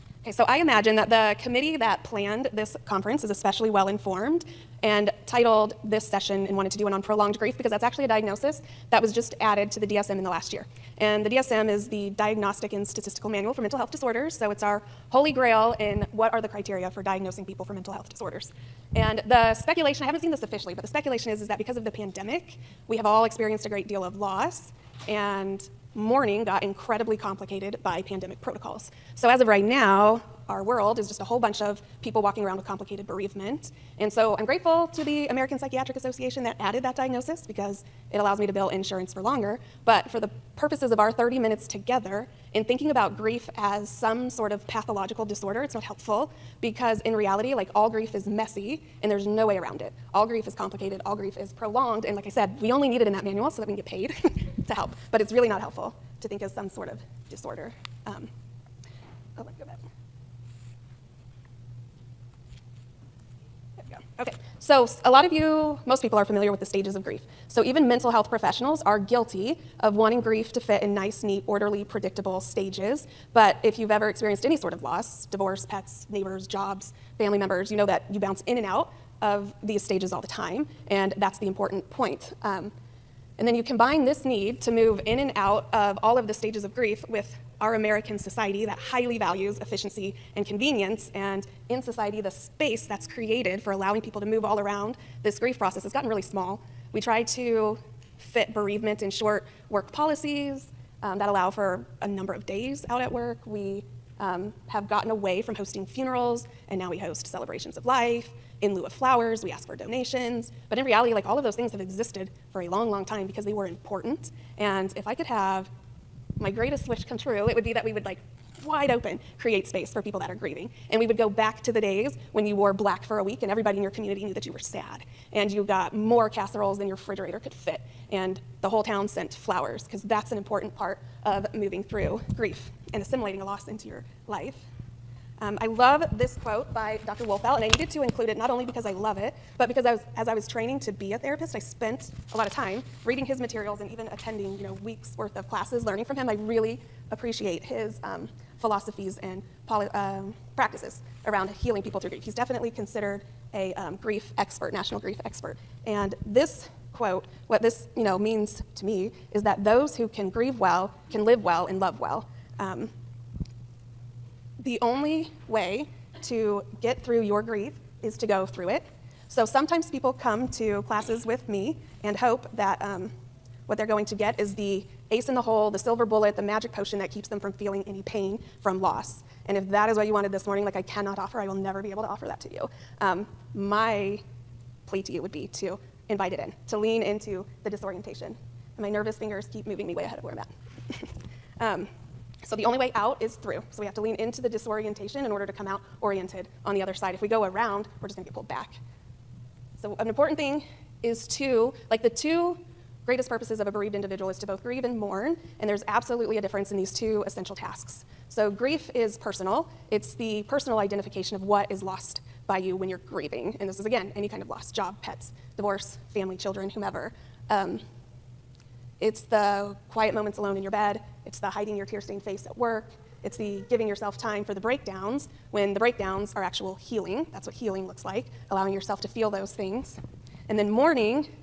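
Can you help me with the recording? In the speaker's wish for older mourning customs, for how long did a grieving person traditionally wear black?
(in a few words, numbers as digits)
a week.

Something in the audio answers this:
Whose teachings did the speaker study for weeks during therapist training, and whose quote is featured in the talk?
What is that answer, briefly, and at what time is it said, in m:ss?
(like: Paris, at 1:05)
Dr. Wolfelt, at 2:17.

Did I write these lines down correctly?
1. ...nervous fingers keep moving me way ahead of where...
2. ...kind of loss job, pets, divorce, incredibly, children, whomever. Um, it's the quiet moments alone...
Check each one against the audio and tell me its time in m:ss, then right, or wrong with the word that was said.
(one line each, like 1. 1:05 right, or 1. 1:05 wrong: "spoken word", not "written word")
1. 3:08 right
2. 3:34 wrong: "family", not "incredibly".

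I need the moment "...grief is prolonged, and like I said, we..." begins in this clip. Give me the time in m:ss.
0:51.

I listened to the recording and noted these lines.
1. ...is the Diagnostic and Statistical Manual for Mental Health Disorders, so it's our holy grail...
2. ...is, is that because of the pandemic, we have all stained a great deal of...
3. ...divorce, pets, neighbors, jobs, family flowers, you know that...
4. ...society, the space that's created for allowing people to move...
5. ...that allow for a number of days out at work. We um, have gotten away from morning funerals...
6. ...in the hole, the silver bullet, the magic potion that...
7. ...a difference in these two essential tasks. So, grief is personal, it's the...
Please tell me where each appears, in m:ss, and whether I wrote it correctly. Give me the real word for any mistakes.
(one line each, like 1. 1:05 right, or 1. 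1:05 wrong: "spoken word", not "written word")
1. 0:11 right
2. 0:21 wrong: "experienced", not "stained"
3. 1:15 wrong: "members", not "flowers"
4. 1:31 right
5. 1:41 wrong: "hosting", not "morning"
6. 2:55 right
7. 3:26 right.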